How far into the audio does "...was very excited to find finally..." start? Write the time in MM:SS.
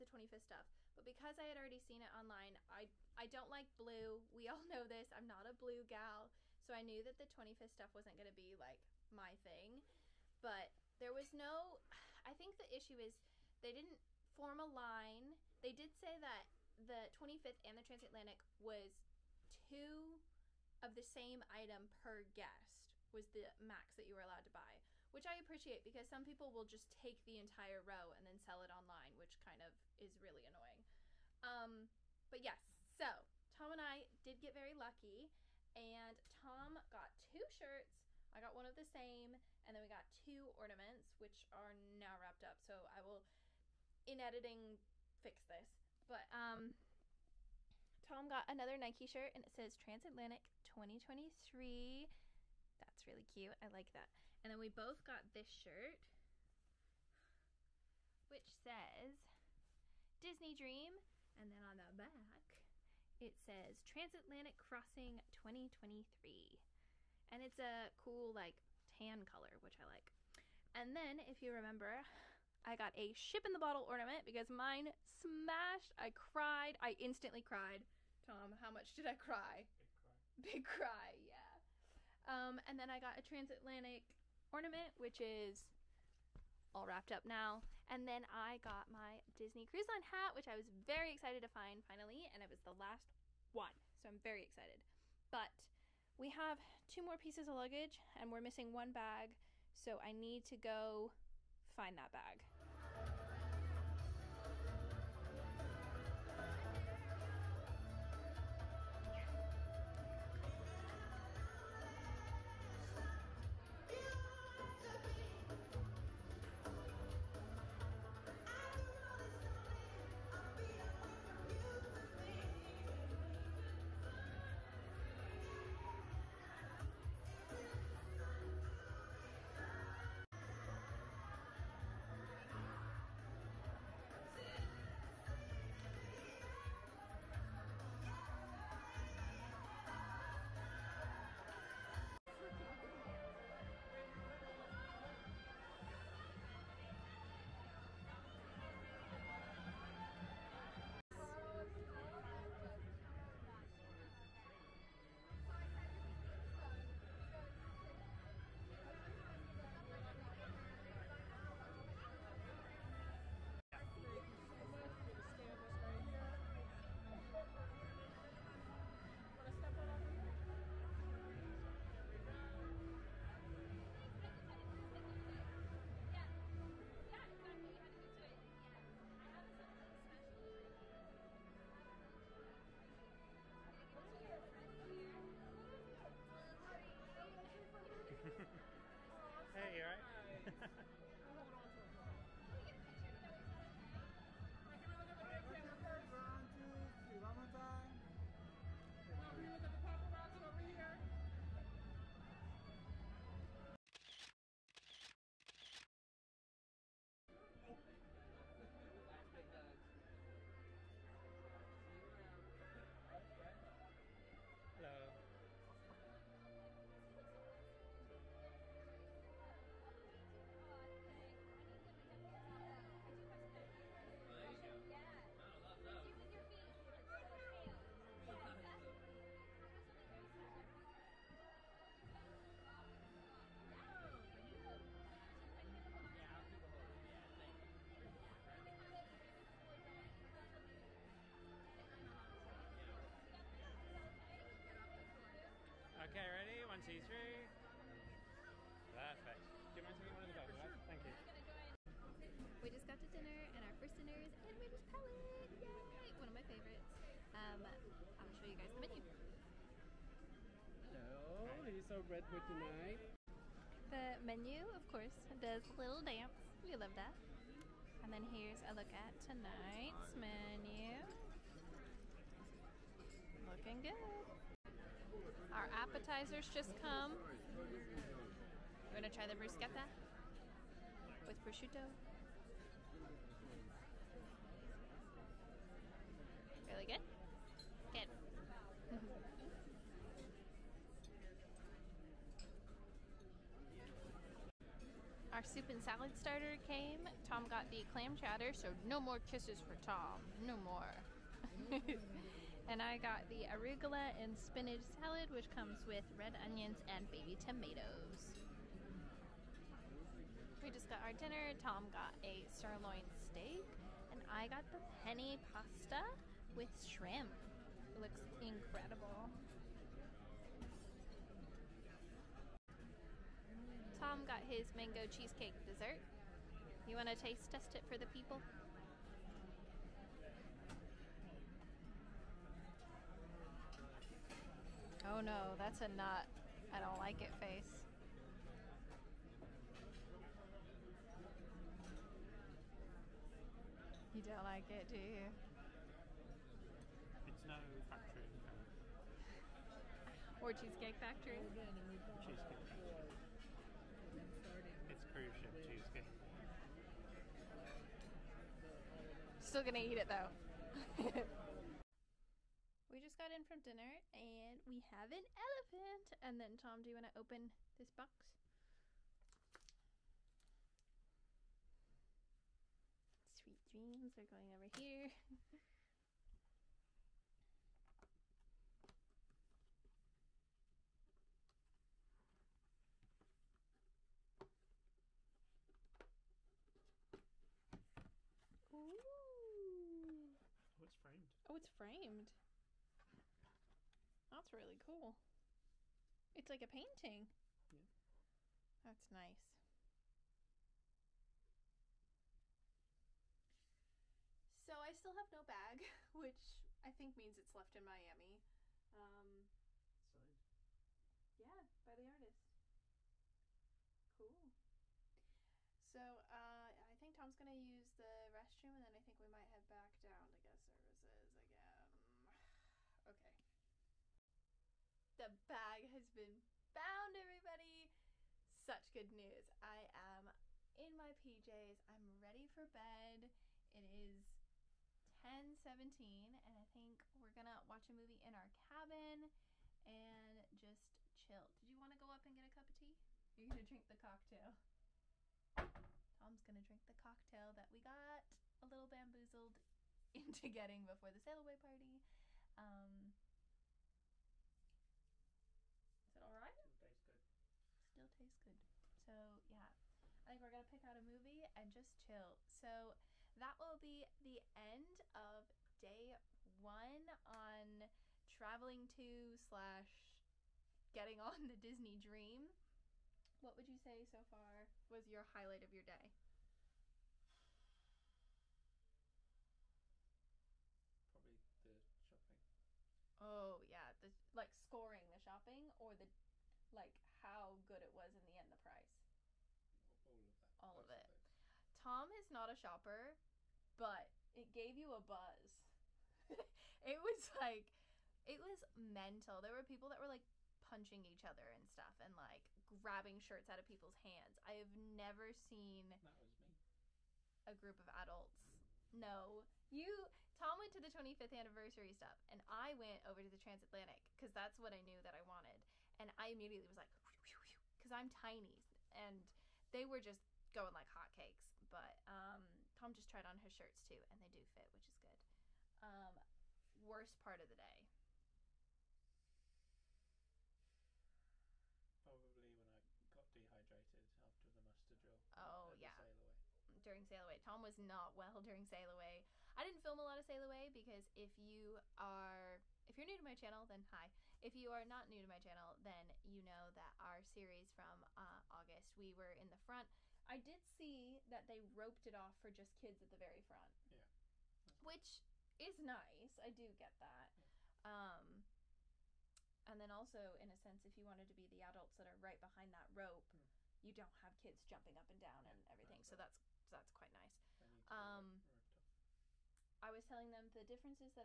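01:30.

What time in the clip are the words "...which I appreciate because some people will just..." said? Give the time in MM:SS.
00:25.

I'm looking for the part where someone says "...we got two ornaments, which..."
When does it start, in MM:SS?
00:39.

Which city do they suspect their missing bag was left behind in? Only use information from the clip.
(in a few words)
Miami.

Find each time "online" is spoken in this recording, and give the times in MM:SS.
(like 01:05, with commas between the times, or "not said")
00:02, 00:28.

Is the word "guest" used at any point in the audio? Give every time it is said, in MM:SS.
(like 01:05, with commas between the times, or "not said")
00:22, 07:00.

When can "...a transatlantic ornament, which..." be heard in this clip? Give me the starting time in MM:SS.
01:23.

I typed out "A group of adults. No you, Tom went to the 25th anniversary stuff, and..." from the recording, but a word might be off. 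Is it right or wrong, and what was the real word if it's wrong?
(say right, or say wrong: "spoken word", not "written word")
right.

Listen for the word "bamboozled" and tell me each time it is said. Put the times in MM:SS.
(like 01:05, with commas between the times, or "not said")
07:28.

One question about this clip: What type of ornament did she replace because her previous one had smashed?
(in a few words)
Ship in the bottle.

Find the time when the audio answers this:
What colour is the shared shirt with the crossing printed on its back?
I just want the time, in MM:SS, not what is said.
01:08.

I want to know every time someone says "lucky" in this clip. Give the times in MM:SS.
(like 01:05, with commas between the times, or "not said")
00:34.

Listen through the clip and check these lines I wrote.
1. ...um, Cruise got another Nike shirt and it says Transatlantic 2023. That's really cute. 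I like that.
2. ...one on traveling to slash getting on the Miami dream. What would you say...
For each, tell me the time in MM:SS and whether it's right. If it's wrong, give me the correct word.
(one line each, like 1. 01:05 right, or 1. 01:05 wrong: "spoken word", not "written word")
1. 00:46 wrong: "Tom", not "Cruise"
2. 07:46 wrong: "Disney", not "Miami".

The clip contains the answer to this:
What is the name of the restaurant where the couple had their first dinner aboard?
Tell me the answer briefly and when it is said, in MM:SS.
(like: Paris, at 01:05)
Animator's Palate, at 04:14.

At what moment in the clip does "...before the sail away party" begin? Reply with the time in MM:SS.
07:30.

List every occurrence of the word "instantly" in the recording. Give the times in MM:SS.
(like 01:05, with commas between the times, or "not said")
01:16.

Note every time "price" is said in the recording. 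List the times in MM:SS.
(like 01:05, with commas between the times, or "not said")
08:08.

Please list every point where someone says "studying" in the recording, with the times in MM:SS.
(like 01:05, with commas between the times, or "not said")
not said.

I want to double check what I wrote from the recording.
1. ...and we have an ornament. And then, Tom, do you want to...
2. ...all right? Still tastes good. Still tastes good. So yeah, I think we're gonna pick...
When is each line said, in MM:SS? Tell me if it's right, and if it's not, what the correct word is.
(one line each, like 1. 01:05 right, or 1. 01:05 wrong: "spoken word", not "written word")
1. 06:04 wrong: "elephant", not "ornament"
2. 07:36 right.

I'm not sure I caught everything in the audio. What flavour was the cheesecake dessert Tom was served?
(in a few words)
Mango.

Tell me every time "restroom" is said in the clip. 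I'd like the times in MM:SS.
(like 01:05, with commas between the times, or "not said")
06:58.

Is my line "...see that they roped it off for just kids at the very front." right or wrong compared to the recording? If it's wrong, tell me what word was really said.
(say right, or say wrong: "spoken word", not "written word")
right.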